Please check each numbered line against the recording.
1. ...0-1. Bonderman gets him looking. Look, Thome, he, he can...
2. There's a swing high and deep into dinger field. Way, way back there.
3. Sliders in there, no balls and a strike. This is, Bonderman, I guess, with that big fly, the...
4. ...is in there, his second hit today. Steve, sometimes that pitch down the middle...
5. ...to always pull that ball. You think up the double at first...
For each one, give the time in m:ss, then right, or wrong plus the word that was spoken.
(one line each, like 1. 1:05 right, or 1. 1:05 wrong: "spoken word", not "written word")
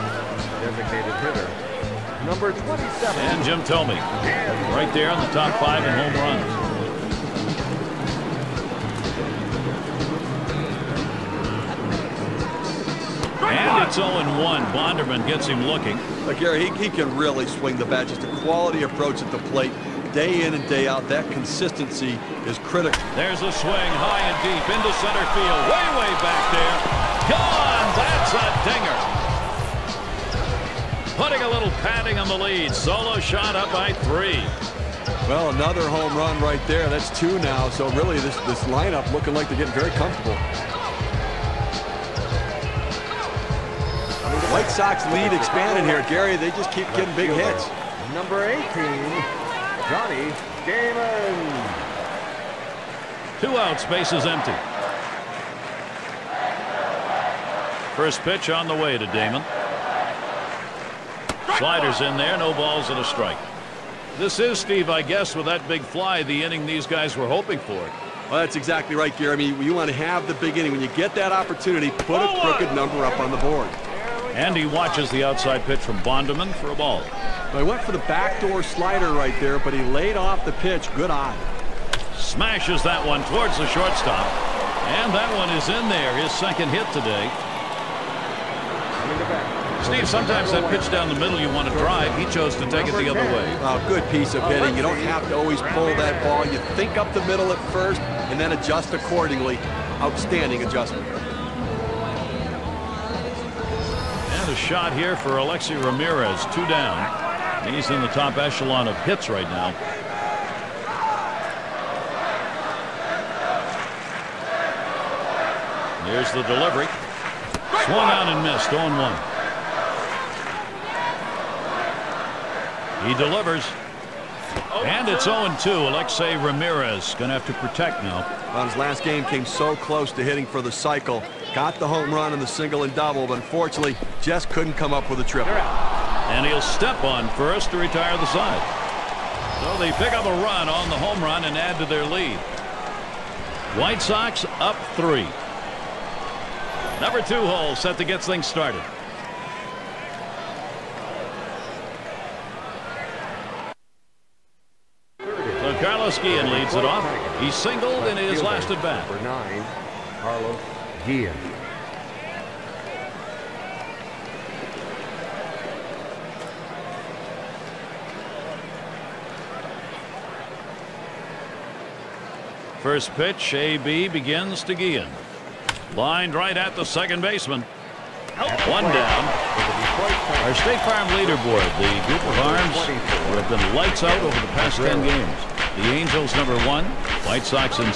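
1. 0:13 wrong: "Gary", not "Thome"
2. 0:23 wrong: "center", not "dinger"
3. 1:01 wrong: "Steve", not "Bonderman"
4. 1:25 right
5. 1:35 wrong: "middle", not "double".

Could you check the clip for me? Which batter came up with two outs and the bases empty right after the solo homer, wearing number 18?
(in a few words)
Johnny Damon.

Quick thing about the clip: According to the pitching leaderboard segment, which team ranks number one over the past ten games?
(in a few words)
Angels.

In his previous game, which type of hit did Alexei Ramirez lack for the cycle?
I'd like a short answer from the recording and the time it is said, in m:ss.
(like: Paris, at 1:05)
Triple, at 2:15.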